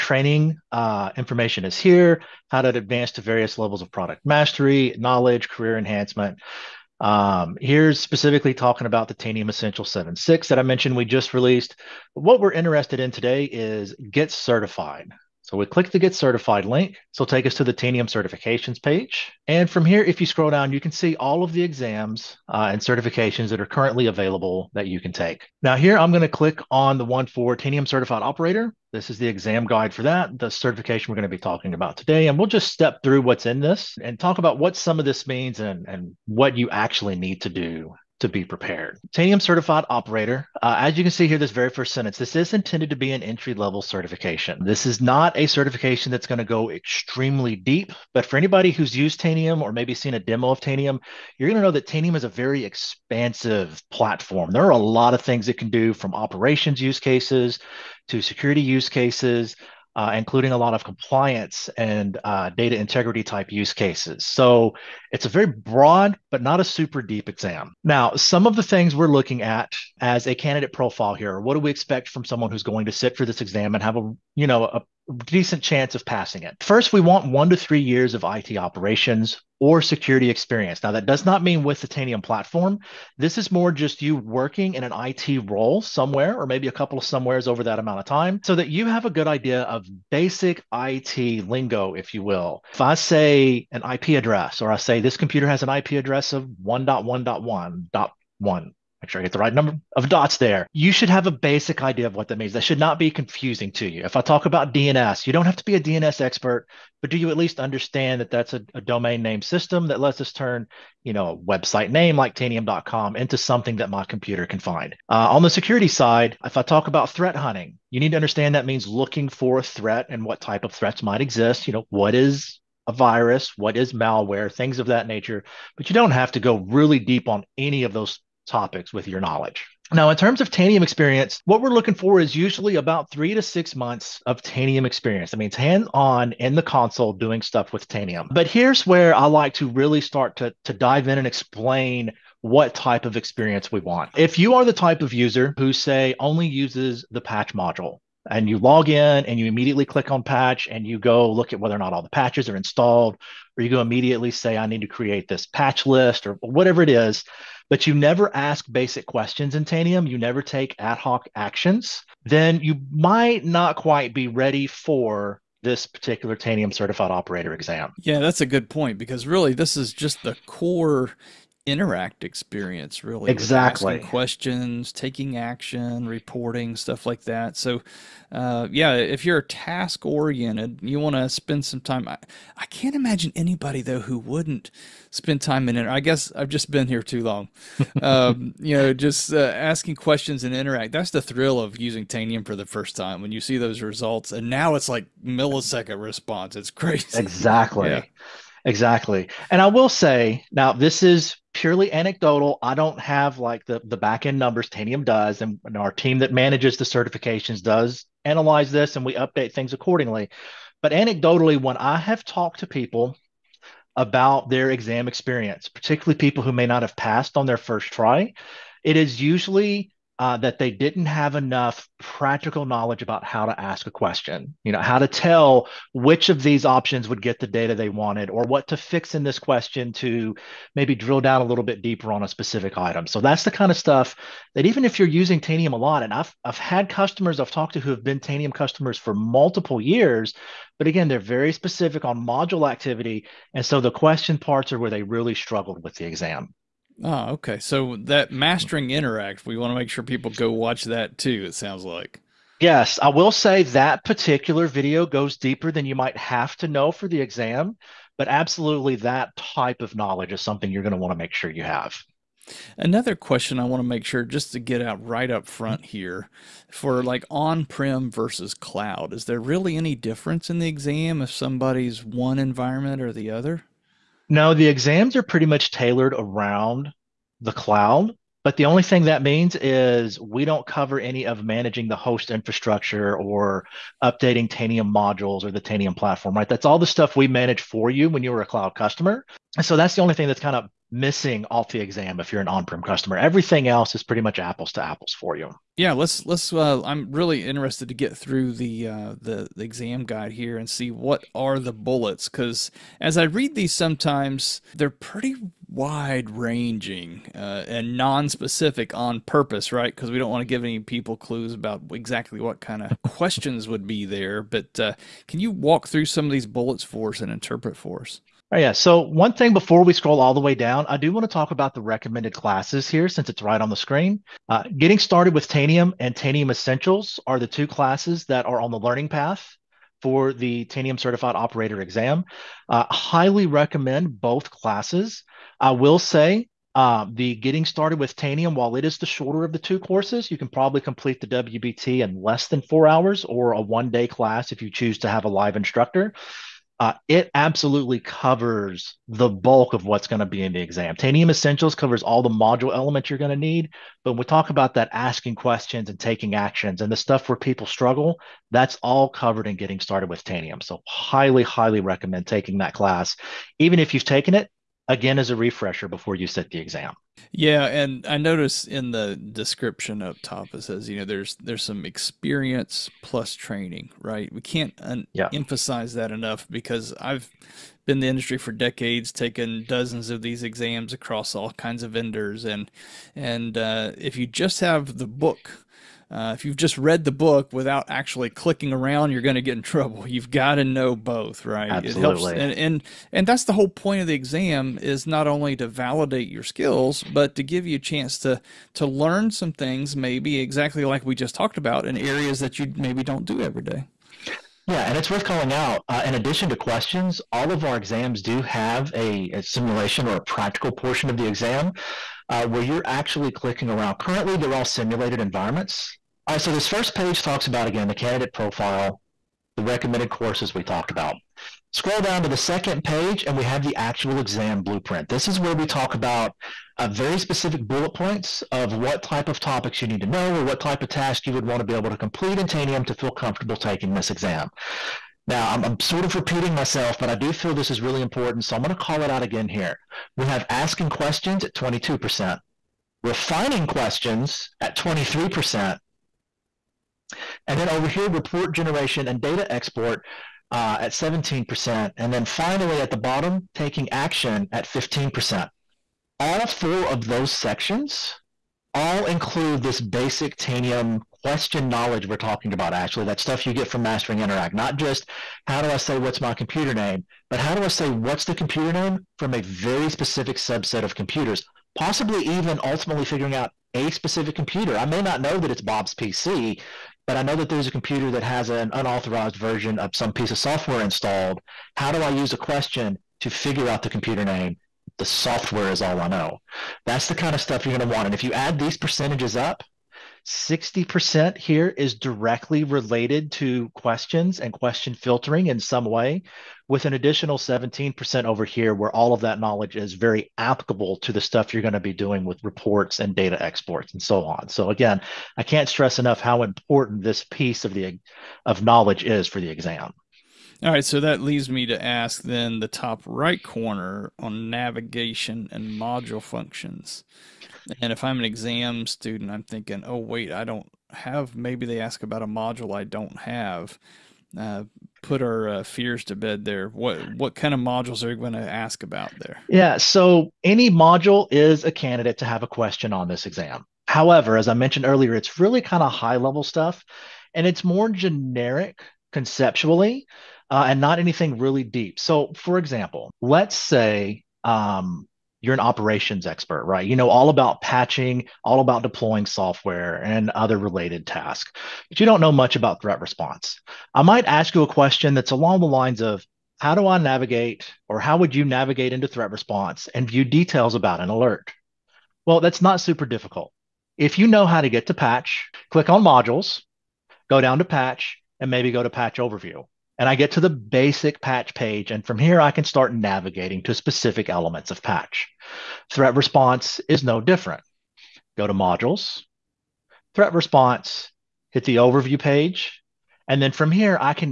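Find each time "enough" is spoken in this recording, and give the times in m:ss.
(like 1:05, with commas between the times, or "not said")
3:41, 6:16, 8:25.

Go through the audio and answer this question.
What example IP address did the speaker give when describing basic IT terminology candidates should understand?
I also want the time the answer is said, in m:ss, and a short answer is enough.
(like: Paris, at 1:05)
1.1.1.1, at 1:36.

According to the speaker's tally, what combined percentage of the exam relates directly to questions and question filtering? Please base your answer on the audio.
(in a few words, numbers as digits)
60%.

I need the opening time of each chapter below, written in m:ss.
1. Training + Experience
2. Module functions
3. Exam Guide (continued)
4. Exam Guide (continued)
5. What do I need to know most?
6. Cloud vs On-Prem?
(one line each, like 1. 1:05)
1. 6:06
2. 8:29
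3. 6:56
4. 4:54
5. 3:19
6. 4:24.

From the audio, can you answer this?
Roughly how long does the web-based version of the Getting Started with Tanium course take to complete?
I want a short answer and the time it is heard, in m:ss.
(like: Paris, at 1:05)
Less than 4 hours, at 5:42.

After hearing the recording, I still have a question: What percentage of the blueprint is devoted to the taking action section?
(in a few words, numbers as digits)
15%.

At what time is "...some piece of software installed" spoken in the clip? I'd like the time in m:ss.
7:59.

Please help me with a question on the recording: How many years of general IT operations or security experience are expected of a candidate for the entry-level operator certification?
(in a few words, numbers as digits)
1 to 3 years.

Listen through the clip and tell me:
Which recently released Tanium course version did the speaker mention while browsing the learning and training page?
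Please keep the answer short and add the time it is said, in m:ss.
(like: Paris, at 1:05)
Tanium Essentials 7.6, at 0:09.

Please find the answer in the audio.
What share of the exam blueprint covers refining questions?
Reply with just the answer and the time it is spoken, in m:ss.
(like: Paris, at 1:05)
23%, at 7:24.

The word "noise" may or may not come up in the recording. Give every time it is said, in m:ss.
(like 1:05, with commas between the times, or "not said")
not said.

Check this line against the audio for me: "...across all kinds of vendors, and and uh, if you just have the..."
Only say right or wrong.
right.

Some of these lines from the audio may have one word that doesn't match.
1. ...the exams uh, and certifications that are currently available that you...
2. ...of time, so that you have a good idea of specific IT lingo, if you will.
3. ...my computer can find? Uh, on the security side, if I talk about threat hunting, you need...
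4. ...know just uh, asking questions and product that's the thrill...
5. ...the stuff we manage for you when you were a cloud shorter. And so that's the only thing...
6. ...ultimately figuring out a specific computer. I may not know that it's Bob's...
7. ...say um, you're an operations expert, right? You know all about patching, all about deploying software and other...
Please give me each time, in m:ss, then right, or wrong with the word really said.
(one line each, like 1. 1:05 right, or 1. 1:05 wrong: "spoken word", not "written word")
1. 0:21 right
2. 1:27 wrong: "basic", not "specific"
3. 1:53 right
4. 3:08 wrong: "interact", not "product"
5. 4:46 wrong: "customer", not "shorter"
6. 7:52 right
7. 9:03 right.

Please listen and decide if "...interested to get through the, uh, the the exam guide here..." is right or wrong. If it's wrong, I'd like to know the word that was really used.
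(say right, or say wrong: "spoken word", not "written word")
right.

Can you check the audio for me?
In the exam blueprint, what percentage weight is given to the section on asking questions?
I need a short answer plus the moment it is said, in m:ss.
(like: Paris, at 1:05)
22%, at 7:21.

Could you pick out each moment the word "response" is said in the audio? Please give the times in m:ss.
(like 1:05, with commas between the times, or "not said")
3:16, 9:13, 9:19, 9:36, 9:40.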